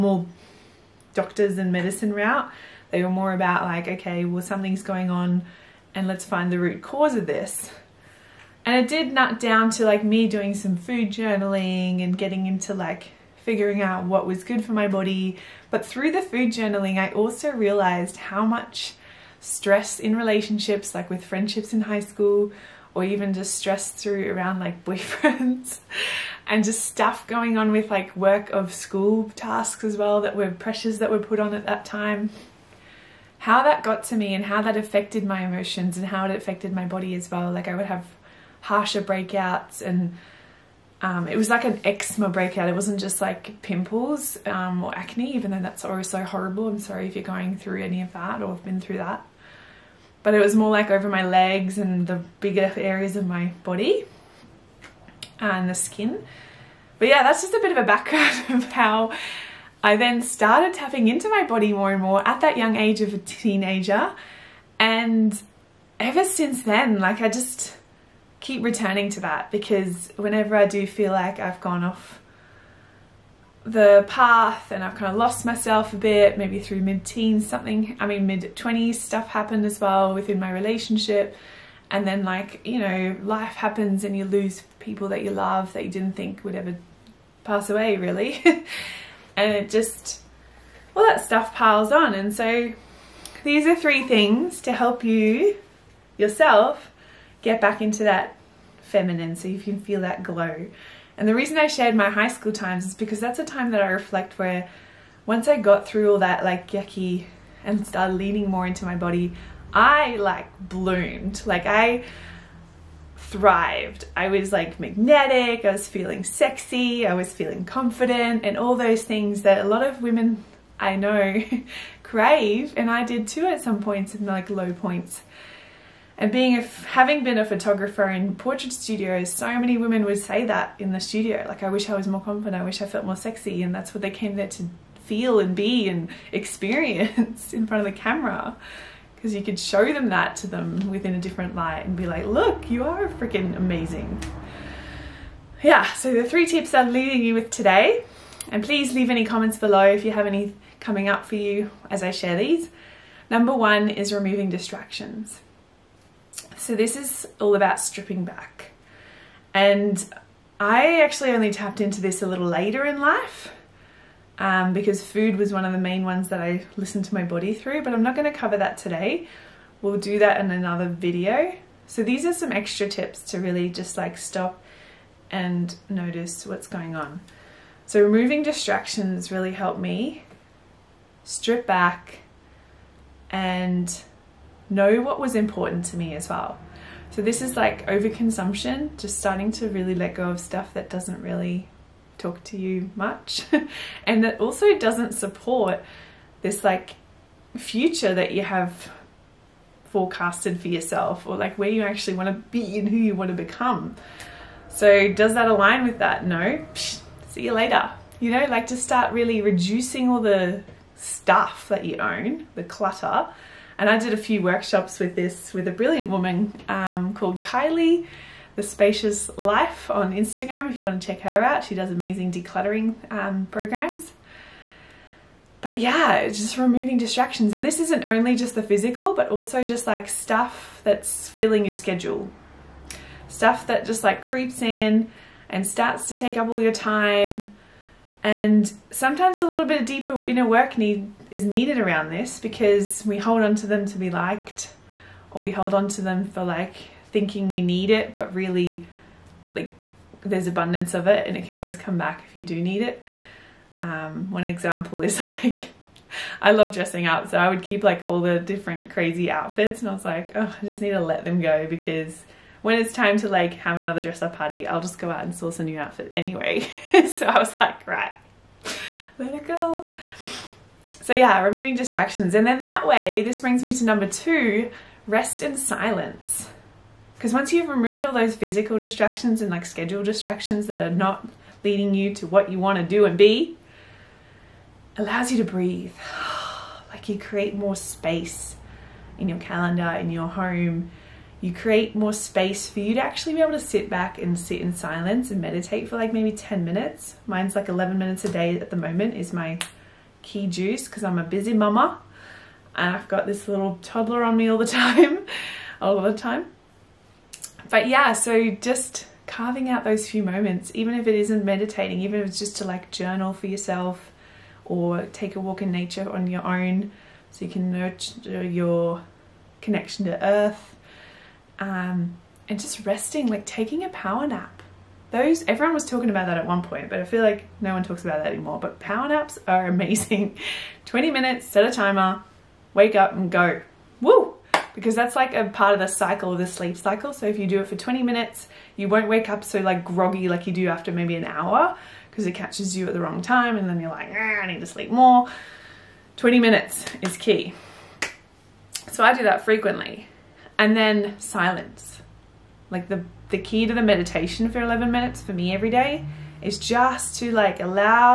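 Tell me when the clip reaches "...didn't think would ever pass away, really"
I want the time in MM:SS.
01:25.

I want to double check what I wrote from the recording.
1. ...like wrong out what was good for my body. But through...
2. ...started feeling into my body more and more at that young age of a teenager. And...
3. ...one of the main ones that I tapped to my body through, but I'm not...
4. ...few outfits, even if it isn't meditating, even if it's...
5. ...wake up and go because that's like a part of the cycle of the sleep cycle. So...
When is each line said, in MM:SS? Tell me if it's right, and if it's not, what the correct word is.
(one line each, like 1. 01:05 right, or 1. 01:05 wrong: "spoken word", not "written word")
1. 00:12 wrong: "figuring", not "wrong"
2. 01:00 wrong: "tapping", not "feeling"
3. 02:45 wrong: "listened", not "tapped"
4. 05:10 wrong: "moments", not "outfits"
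5. 05:32 right.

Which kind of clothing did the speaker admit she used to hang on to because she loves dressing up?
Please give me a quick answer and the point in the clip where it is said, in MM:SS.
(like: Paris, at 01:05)
Crazy outfits, at 04:18.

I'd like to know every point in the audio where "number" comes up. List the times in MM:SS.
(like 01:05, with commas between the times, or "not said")
02:33, 04:33.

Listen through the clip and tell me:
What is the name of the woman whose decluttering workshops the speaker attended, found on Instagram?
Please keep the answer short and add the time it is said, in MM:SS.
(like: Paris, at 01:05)
Kylie, at 03:37.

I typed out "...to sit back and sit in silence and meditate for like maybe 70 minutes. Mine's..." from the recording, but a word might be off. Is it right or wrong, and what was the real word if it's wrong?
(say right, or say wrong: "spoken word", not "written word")
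wrong: "10", not "70".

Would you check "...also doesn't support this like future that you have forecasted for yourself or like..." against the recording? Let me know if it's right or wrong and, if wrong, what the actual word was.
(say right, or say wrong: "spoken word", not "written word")
right.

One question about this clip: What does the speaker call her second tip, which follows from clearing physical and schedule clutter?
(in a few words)
Rest in silence.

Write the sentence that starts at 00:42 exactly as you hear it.
It wasn't just like pimples um, or acne, even though that's always so horrible.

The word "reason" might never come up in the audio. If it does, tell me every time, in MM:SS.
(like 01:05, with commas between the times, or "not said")
01:41.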